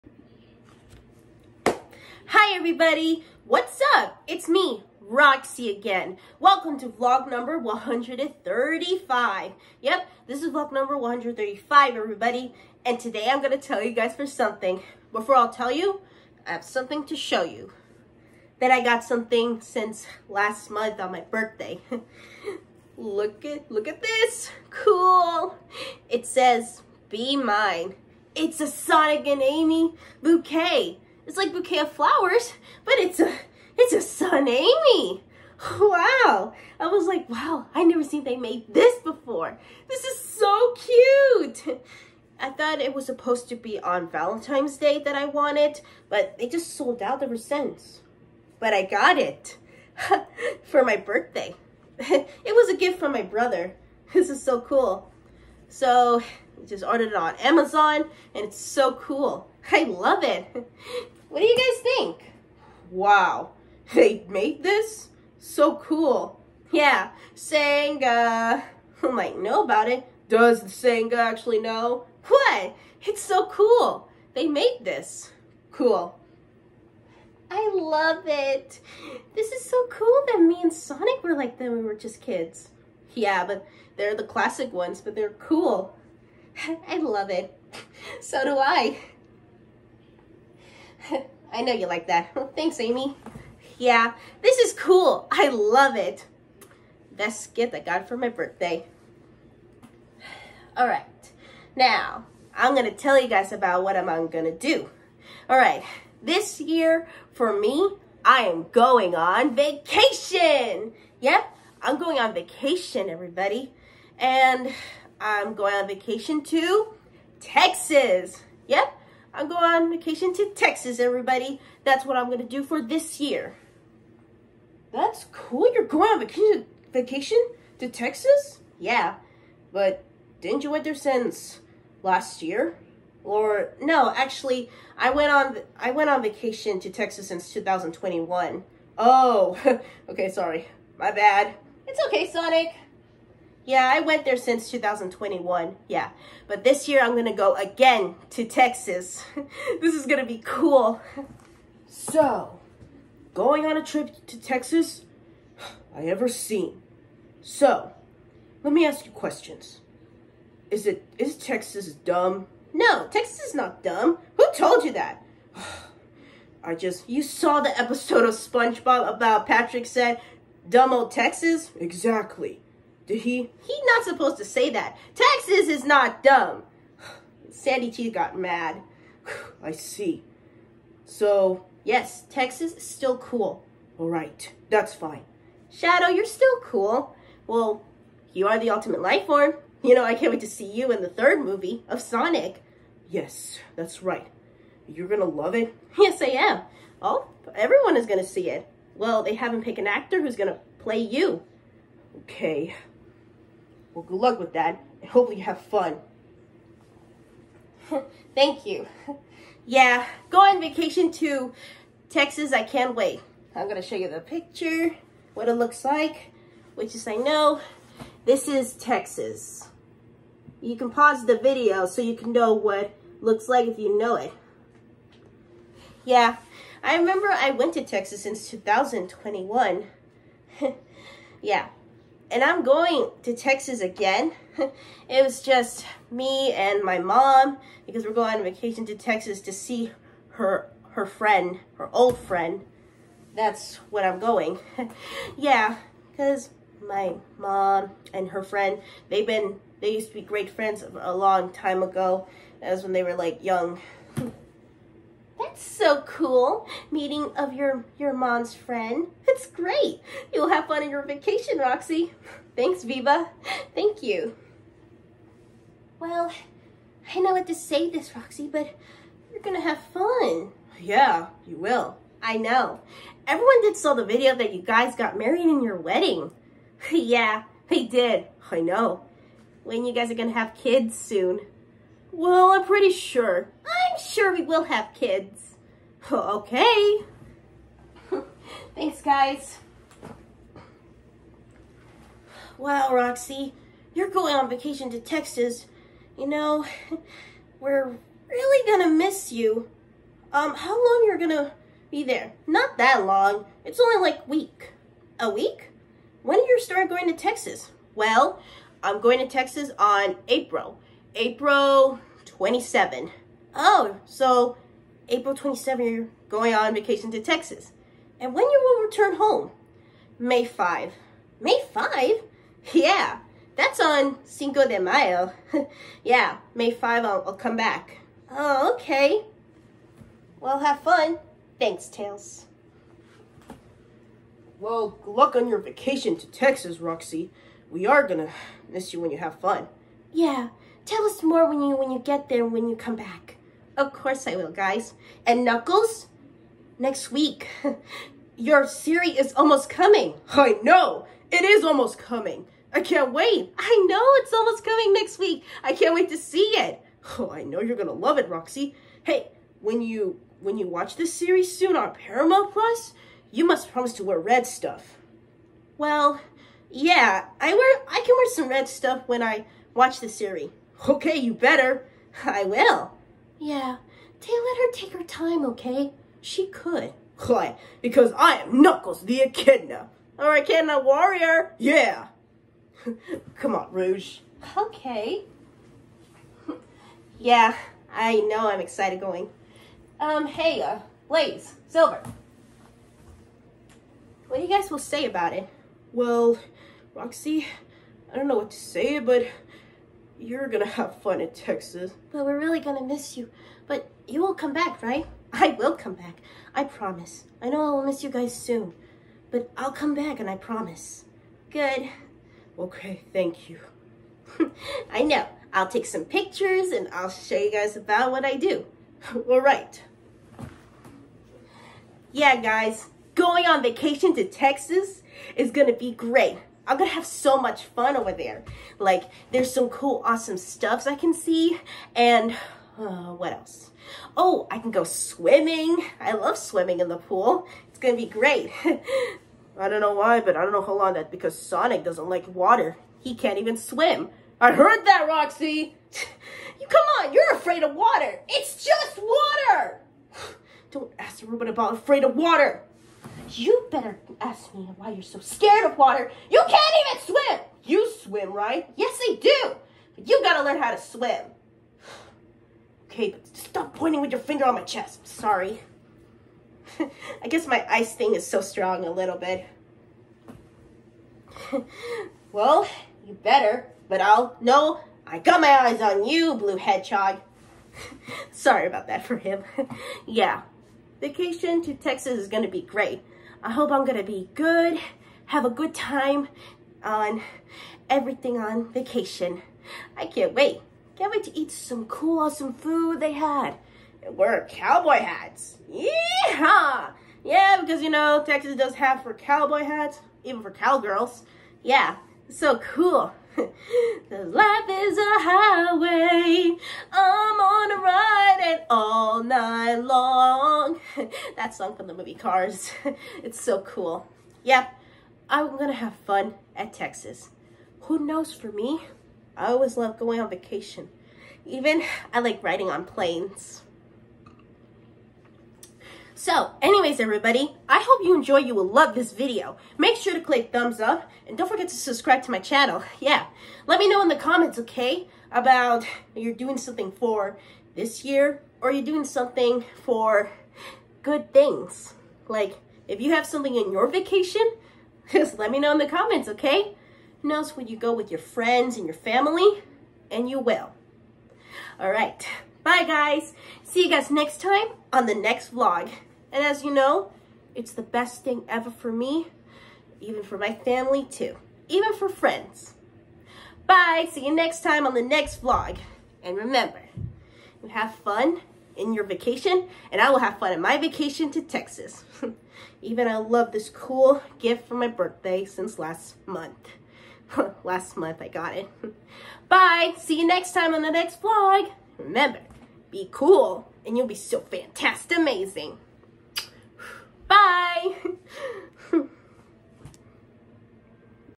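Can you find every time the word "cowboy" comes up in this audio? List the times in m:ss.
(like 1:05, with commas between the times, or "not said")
8:14, 8:19.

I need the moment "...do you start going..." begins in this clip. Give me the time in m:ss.
5:06.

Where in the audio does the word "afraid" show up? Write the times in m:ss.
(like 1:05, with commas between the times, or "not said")
7:27, 7:31.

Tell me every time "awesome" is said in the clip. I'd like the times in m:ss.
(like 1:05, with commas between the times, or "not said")
7:10, 8:12.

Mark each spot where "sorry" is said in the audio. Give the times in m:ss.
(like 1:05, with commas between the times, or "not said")
2:20, 7:45, 7:58.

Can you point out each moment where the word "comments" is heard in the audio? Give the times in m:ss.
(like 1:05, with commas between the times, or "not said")
8:54, 9:05.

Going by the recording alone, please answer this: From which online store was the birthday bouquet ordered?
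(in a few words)
Amazon.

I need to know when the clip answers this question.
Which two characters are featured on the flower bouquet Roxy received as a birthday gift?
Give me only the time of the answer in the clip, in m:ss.
0:28.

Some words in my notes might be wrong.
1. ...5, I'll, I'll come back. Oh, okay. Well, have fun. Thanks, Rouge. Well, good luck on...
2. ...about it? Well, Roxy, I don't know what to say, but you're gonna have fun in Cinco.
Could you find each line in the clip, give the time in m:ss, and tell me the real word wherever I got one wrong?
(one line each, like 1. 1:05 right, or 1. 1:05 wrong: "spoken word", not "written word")
1. 5:26 wrong: "Tails", not "Rouge"
2. 6:35 wrong: "Texas", not "Cinco".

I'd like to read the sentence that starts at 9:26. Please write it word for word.
And remember, you have fun in your vacation, and I will have fun in my vacation to Texas.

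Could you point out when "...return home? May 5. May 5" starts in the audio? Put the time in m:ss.
5:18.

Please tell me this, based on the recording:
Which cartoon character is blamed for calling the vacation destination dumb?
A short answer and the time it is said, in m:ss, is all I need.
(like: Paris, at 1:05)
Patrick, at 2:49.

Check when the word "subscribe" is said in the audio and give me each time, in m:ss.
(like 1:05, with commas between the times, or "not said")
8:51.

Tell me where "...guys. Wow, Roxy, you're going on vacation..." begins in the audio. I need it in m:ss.
4:49.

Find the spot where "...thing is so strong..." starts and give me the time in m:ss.
7:47.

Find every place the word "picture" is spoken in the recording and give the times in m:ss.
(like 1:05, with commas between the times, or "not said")
3:34, 6:56.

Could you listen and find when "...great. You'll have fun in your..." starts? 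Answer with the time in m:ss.
4:19.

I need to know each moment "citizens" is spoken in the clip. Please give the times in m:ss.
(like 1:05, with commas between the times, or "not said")
not said.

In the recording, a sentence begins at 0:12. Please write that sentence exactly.
And today I'm gonna tell you guys for something.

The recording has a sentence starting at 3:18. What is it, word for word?
Well, they haven't picked an actor who's gonna play you.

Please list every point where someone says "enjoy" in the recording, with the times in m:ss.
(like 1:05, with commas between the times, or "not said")
8:48.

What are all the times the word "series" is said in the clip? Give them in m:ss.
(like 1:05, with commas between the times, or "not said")
5:48, 6:01, 6:10.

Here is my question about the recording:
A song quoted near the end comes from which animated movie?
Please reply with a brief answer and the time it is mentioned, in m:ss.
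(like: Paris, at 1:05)
Cars, at 8:32.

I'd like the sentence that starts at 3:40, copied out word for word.
You can pause the video so you can know what looks like if you know it.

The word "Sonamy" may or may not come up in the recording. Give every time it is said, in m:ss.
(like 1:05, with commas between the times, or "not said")
0:34.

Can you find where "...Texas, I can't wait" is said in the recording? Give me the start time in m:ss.
3:32.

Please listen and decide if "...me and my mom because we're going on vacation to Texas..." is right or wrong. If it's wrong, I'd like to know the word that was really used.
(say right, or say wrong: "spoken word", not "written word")
right.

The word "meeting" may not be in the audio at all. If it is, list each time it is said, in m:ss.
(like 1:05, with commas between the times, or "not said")
4:16.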